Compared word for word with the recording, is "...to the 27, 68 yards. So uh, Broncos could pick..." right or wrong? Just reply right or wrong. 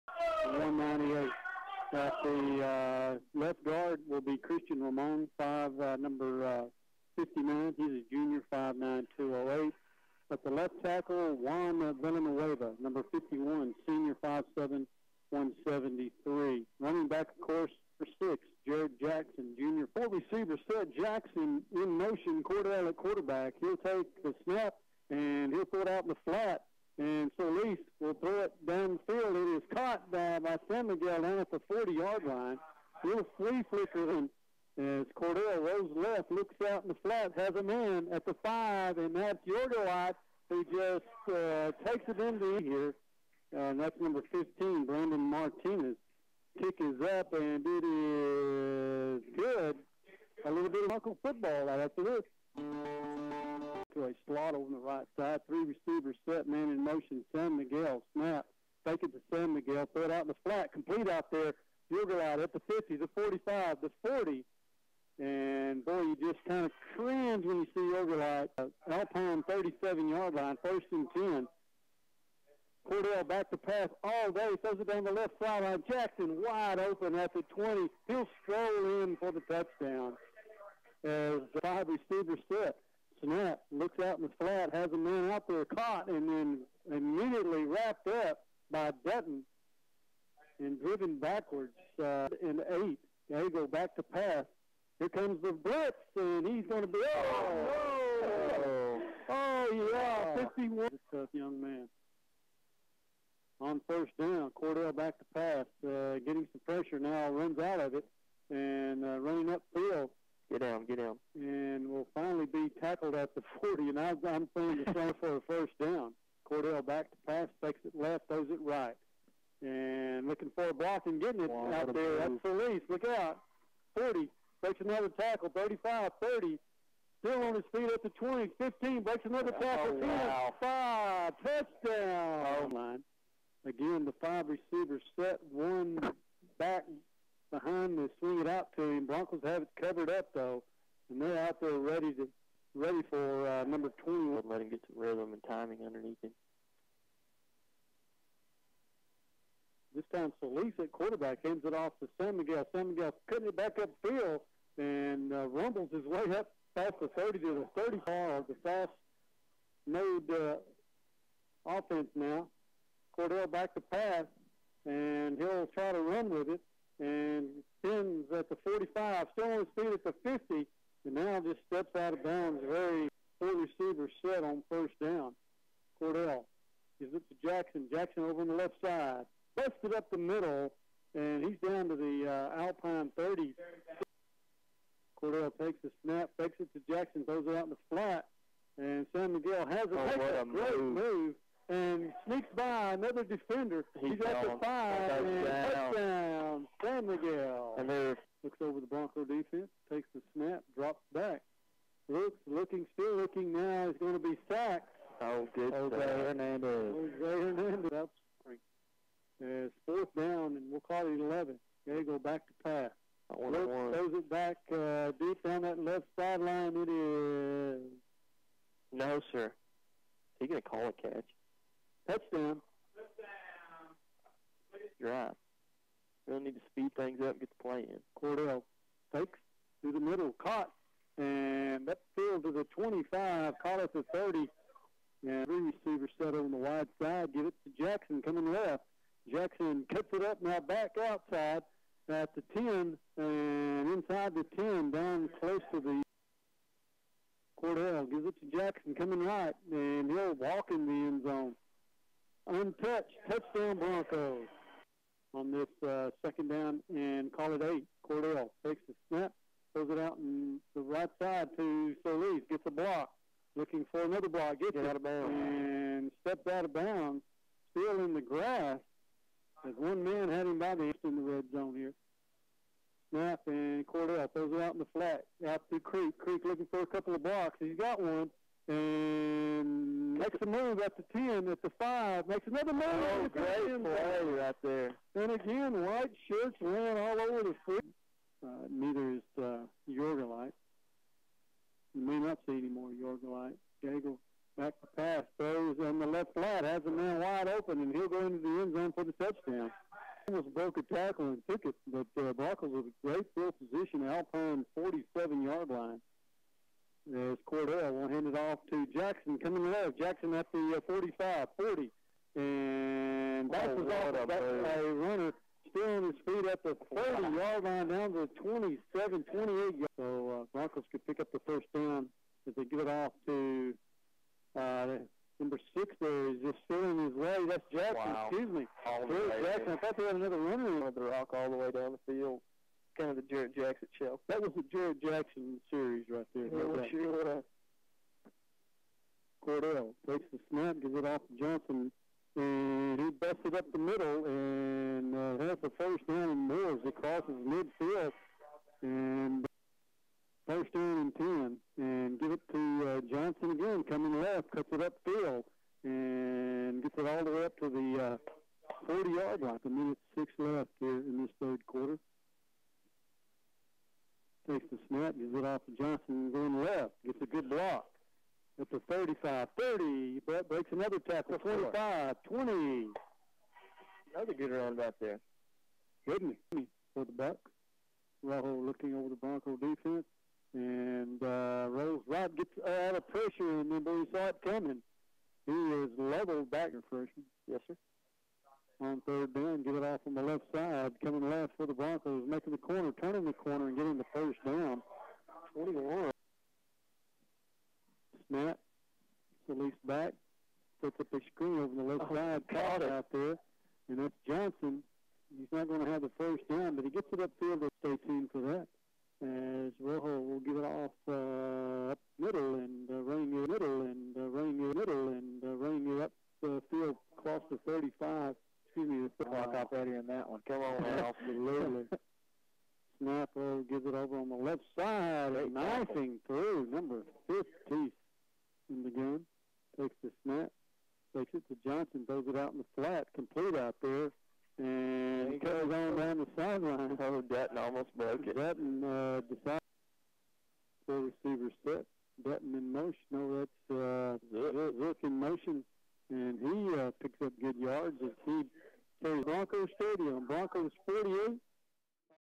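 wrong.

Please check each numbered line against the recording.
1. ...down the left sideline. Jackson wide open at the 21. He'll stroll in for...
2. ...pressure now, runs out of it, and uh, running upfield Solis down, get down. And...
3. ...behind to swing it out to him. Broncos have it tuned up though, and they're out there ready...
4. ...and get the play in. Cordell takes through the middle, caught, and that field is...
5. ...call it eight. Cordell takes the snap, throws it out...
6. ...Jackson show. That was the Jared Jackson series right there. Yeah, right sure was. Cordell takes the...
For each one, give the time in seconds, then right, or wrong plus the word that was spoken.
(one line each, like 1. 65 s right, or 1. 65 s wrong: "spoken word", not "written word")
1. 74 s wrong: "20", not "21"
2. 106 s wrong: "Get", not "Solis"
3. 137 s wrong: "covered", not "tuned"
4. 227 s right
5. 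257 s right
6. 333 s right.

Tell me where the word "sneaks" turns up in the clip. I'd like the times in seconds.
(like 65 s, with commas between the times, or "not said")
192 s.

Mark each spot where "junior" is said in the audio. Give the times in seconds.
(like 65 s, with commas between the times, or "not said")
8 s, 19 s.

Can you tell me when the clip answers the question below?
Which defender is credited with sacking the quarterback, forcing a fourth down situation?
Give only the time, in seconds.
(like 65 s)
205 s.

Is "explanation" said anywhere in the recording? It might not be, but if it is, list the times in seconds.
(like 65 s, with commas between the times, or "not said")
not said.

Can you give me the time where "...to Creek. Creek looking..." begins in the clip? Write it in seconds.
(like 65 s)
275 s.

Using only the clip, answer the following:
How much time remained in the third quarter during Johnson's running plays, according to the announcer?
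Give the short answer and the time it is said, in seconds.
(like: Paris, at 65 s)
1 minute 6 seconds, at 359 s.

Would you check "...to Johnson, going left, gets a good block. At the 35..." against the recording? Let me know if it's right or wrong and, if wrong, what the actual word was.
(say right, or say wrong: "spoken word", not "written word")
right.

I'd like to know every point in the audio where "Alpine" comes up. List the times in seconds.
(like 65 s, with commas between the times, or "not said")
68 s, 182 s, 304 s.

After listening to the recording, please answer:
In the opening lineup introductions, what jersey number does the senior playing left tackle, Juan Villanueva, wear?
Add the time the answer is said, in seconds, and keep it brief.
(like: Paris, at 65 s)
51, at 12 s.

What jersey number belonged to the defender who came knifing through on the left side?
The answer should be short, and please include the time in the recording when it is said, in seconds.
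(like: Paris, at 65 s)
50, at 426 s.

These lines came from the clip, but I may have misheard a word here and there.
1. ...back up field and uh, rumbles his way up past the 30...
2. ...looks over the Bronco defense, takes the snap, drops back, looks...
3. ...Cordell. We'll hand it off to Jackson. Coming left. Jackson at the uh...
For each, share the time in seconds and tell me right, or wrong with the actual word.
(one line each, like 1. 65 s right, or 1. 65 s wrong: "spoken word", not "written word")
1. 153 s right
2. 198 s right
3. 307 s right.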